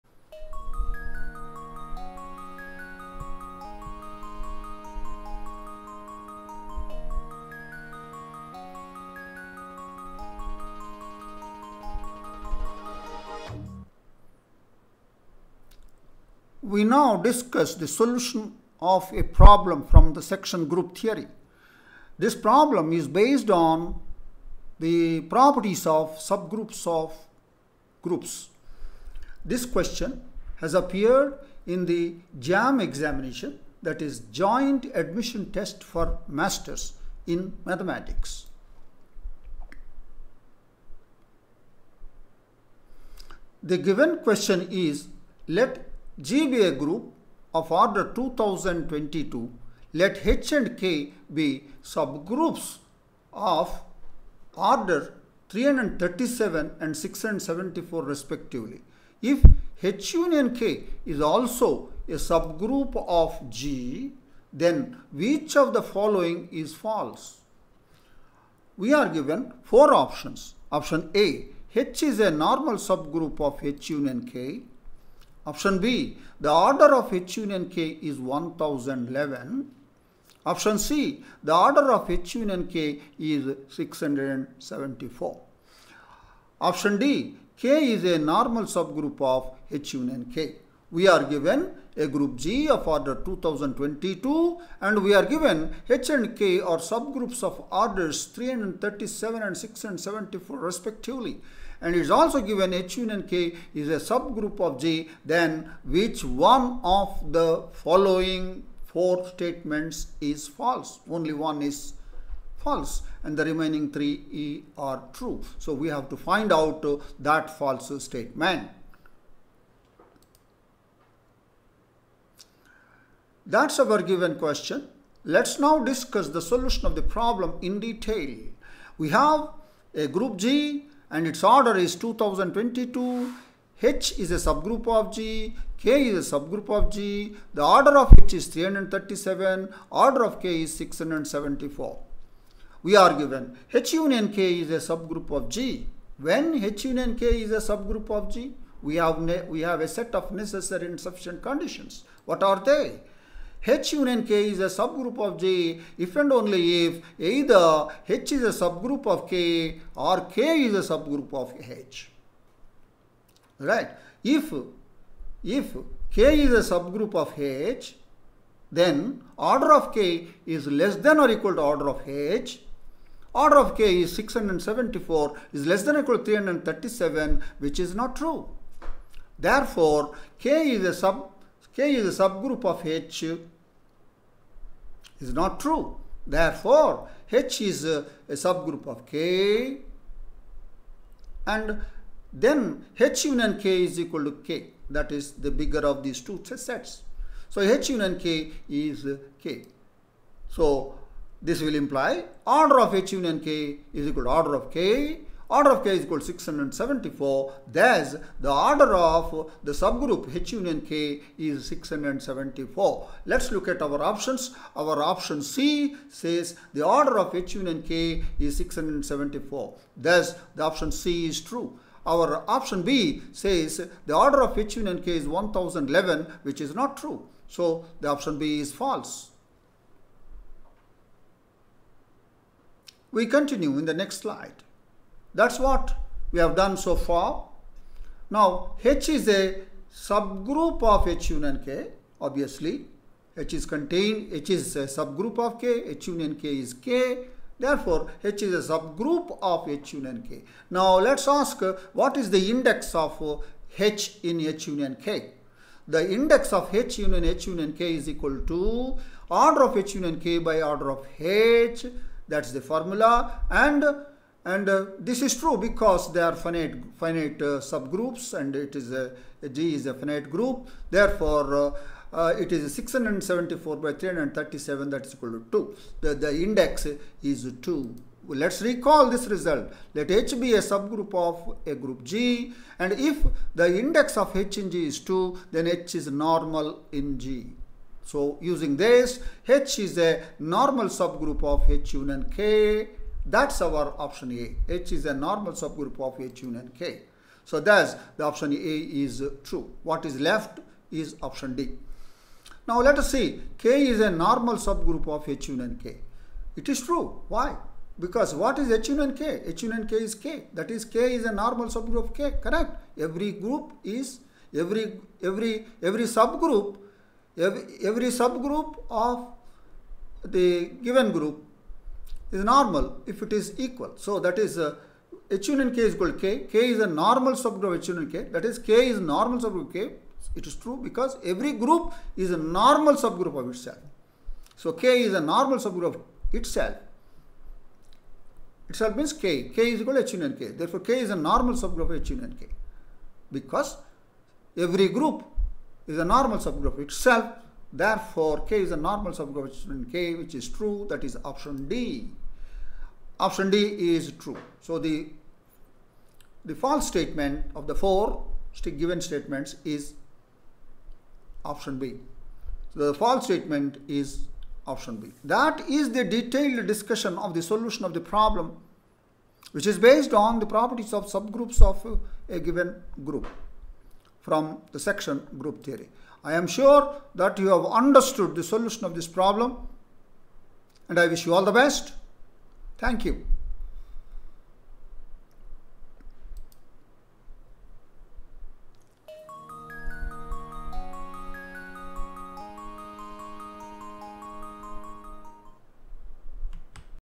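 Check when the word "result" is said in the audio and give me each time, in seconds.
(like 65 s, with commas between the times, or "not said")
279 s.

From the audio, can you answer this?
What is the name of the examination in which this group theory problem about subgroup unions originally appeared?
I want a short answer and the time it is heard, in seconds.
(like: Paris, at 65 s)
JAM, at 32 s.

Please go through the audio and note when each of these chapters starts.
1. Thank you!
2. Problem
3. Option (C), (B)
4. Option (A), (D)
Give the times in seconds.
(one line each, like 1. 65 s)
1. 376 s
2. 41 s
3. 121 s
4. 231 s.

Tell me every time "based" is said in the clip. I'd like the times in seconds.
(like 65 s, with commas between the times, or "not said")
23 s, 369 s.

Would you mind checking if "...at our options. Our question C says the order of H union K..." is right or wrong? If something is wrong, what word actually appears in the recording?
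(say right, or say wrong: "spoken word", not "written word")
wrong: "option", not "question".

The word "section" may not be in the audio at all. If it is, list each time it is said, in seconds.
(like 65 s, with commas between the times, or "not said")
20 s, 374 s.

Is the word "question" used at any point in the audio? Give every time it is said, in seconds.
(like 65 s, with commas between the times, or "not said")
29 s, 44 s, 124 s.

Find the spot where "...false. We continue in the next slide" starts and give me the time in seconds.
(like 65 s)
228 s.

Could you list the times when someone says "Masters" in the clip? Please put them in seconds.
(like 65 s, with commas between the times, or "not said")
36 s.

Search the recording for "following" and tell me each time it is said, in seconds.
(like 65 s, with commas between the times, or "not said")
65 s, 107 s.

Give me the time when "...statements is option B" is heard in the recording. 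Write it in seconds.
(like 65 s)
358 s.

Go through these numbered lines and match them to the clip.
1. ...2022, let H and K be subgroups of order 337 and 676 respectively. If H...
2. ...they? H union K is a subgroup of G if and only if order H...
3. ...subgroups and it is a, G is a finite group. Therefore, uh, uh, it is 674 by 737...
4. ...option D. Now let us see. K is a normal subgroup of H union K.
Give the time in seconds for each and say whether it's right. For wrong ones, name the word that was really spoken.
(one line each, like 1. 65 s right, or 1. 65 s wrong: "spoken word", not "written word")
1. 48 s wrong: "674", not "676"
2. 152 s wrong: "either", not "order"
3. 267 s wrong: "337", not "737"
4. 301 s right.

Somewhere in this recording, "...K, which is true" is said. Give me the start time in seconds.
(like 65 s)
349 s.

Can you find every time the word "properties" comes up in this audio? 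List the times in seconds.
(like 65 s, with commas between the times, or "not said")
25 s, 370 s.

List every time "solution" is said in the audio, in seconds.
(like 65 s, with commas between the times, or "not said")
17 s, 126 s, 367 s, 378 s.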